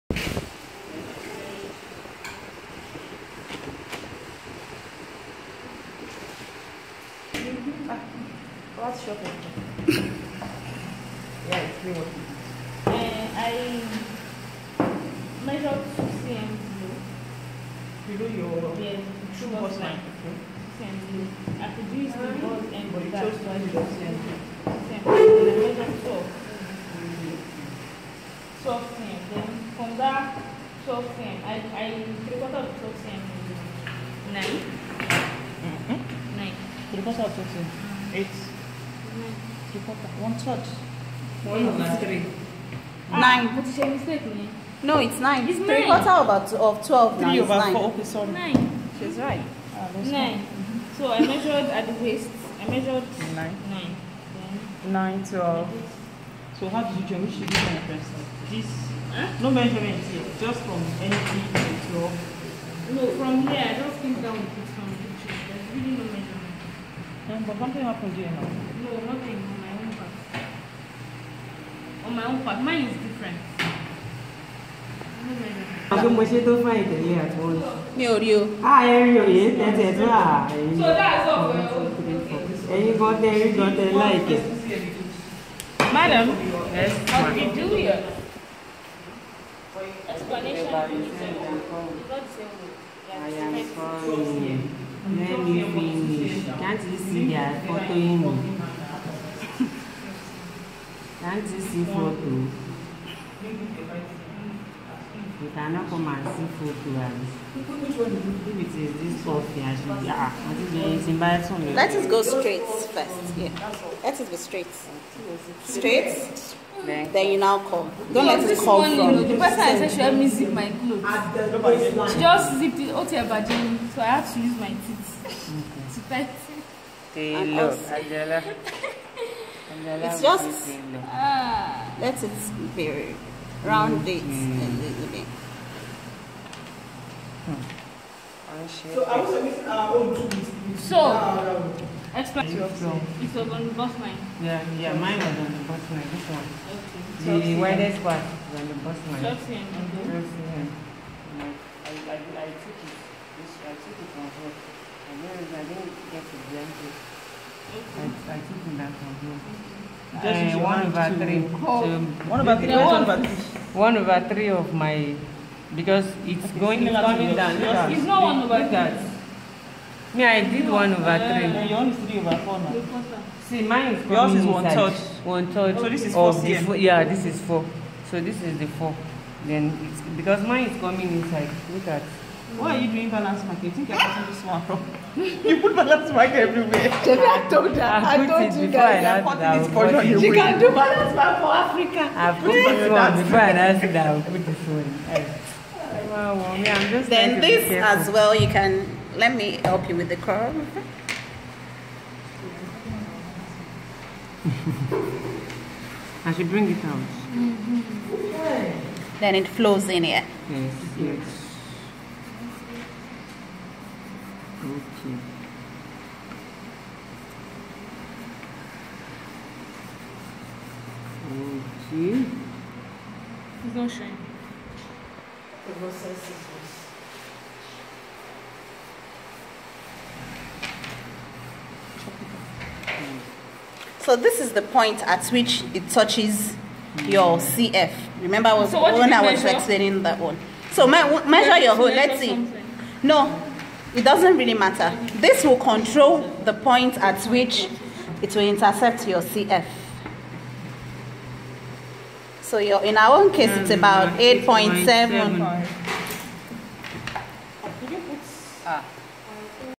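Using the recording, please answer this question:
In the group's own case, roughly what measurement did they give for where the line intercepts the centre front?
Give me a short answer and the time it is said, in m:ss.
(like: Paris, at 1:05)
8.7, at 4:14.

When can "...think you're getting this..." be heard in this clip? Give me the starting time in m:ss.
3:03.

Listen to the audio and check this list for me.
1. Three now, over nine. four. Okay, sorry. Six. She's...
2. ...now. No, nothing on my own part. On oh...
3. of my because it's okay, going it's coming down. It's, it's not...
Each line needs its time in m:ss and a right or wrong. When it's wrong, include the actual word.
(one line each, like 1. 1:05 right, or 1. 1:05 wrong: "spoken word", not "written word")
1. 0:47 wrong: "Nine", not "Six"
2. 1:08 right
3. 2:44 right.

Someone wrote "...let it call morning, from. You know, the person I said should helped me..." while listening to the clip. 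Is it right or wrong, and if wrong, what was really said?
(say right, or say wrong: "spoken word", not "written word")
right.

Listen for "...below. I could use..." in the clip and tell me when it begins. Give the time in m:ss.
0:21.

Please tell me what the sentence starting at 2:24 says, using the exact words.
Yeah, yeah, mine was on the bust line.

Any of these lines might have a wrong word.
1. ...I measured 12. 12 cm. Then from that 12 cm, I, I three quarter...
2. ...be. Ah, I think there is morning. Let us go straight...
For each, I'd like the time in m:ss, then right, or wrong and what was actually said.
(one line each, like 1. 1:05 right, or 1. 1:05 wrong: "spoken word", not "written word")
1. 0:25 right
2. 1:49 wrong: "embarrassing", not "morning".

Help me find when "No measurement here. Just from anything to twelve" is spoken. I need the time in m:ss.
0:59.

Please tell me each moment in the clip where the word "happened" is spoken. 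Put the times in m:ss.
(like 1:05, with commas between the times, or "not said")
1:07.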